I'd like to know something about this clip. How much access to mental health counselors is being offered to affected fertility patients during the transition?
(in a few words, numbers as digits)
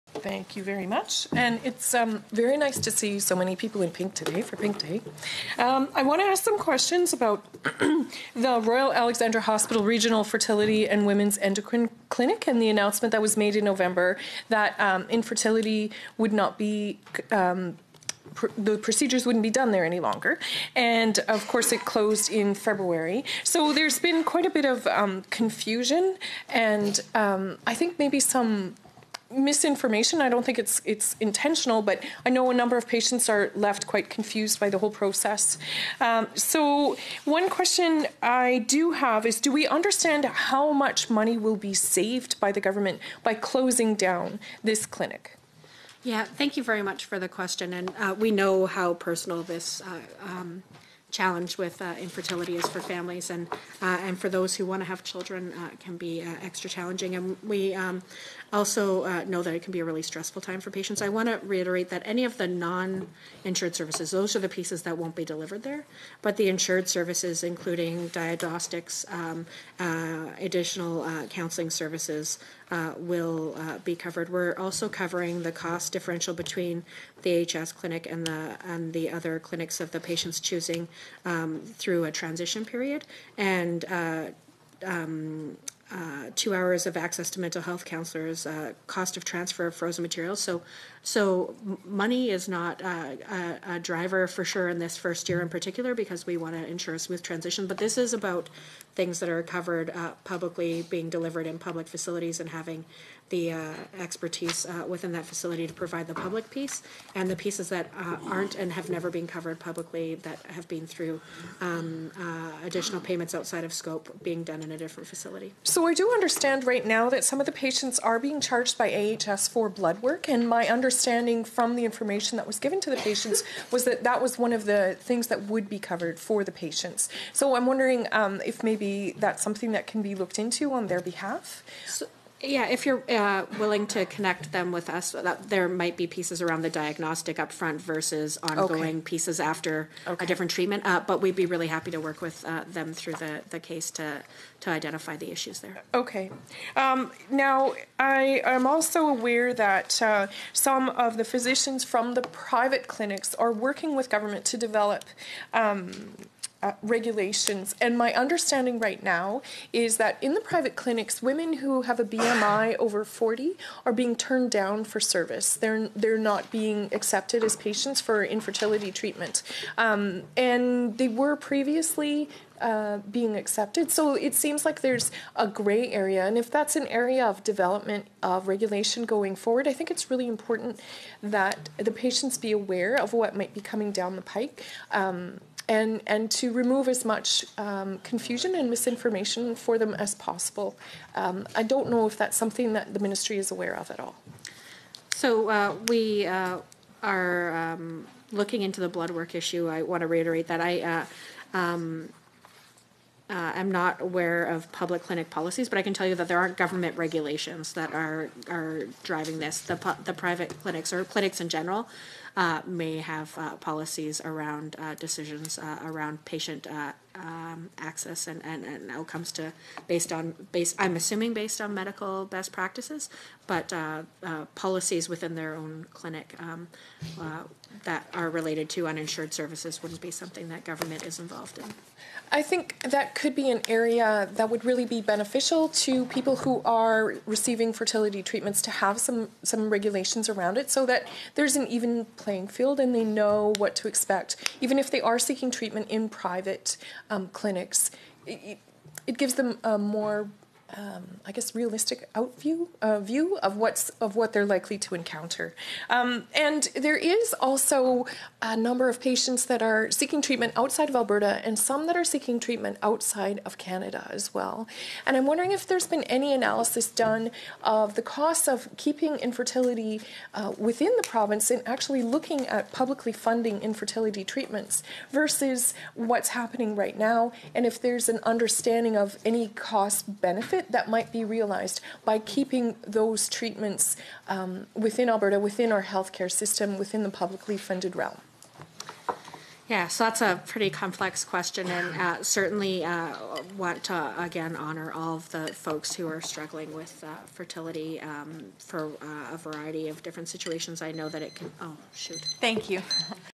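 2 hours.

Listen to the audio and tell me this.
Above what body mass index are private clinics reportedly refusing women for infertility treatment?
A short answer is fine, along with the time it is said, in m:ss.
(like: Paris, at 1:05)
40, at 2:43.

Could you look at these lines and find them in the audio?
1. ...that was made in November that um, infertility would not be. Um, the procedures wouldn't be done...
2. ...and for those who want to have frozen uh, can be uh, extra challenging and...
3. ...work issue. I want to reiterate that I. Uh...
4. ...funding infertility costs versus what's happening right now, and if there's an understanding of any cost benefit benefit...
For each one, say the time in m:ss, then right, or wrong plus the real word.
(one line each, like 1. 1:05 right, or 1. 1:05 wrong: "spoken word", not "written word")
1. 0:13 right
2. 0:54 wrong: "children", not "frozen"
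3. 3:19 right
4. 4:33 wrong: "treatments", not "costs".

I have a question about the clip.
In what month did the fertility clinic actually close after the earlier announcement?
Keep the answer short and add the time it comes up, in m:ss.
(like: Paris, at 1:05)
February, at 0:22.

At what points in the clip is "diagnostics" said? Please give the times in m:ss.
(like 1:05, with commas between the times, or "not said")
1:08, 2:16.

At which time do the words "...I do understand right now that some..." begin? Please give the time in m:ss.
1:55.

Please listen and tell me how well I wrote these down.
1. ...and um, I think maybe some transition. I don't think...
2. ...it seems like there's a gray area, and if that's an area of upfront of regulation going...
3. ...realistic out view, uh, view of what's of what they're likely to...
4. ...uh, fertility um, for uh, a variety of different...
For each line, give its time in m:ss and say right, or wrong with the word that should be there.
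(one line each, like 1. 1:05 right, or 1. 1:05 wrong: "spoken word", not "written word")
1. 0:26 wrong: "misinformation", not "transition"
2. 2:54 wrong: "development", not "upfront"
3. 4:11 right
4. 4:57 right.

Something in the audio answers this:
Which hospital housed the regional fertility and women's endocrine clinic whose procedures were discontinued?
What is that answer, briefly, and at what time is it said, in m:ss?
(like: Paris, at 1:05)
Royal Alexandra Hospital, at 0:08.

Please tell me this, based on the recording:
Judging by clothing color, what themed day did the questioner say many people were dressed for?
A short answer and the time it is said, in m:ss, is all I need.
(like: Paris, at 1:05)
Pink Day, at 0:04.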